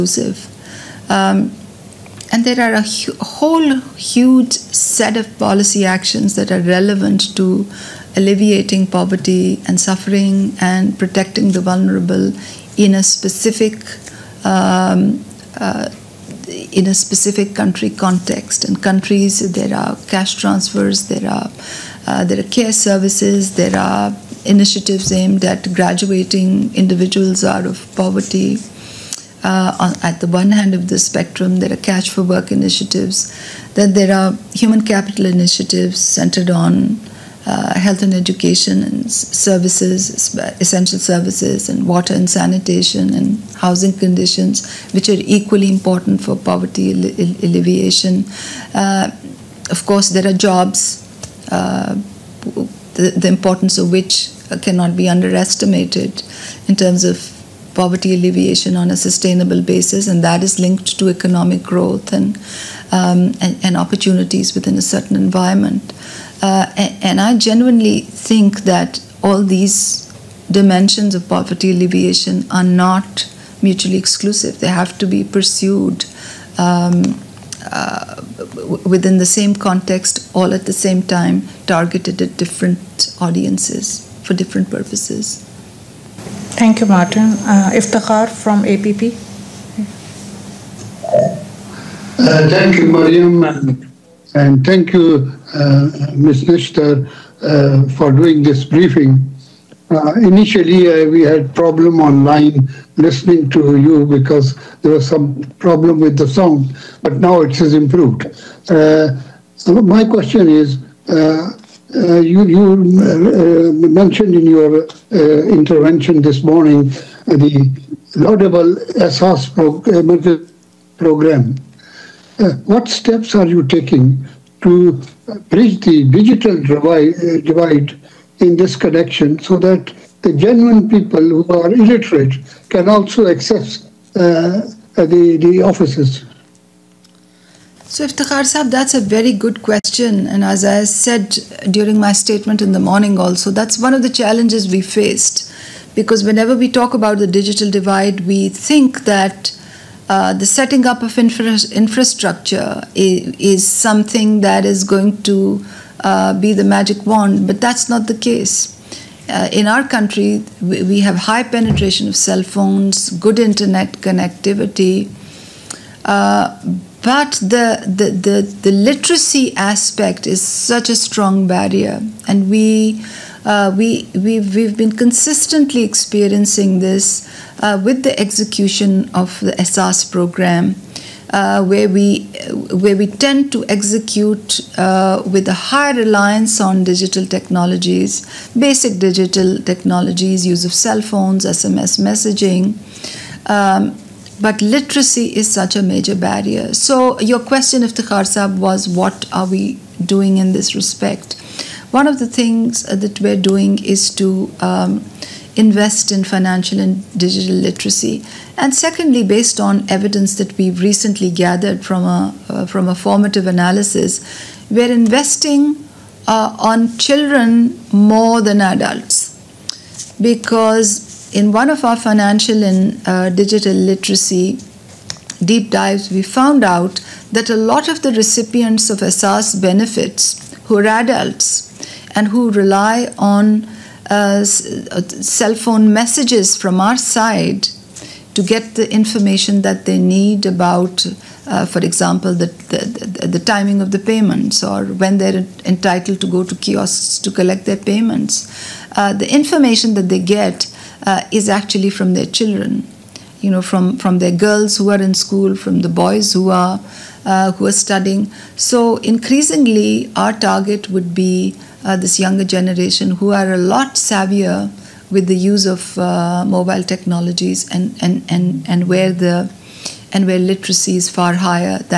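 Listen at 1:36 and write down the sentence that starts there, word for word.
Nishtar, uh, for doing this briefing.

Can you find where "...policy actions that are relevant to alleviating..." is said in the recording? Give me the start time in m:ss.
0:05.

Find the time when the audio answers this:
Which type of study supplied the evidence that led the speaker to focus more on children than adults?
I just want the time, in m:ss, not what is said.
3:32.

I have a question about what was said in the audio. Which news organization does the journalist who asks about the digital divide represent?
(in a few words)
APP.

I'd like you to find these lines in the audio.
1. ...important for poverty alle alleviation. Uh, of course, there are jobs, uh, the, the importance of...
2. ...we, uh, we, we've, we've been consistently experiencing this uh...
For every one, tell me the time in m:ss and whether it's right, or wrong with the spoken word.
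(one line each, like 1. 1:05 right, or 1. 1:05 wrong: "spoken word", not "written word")
1. 0:45 right
2. 2:52 right.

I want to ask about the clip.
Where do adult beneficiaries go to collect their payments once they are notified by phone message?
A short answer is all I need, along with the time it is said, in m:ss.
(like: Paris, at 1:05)
kiosks, at 4:06.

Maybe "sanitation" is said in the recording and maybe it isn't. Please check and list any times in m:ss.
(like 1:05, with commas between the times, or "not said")
0:42.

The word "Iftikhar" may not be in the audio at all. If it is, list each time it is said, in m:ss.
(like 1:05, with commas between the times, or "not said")
1:27, 2:18, 3:17.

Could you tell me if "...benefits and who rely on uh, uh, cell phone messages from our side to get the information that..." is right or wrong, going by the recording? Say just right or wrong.
wrong.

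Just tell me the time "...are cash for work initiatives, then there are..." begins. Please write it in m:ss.
0:31.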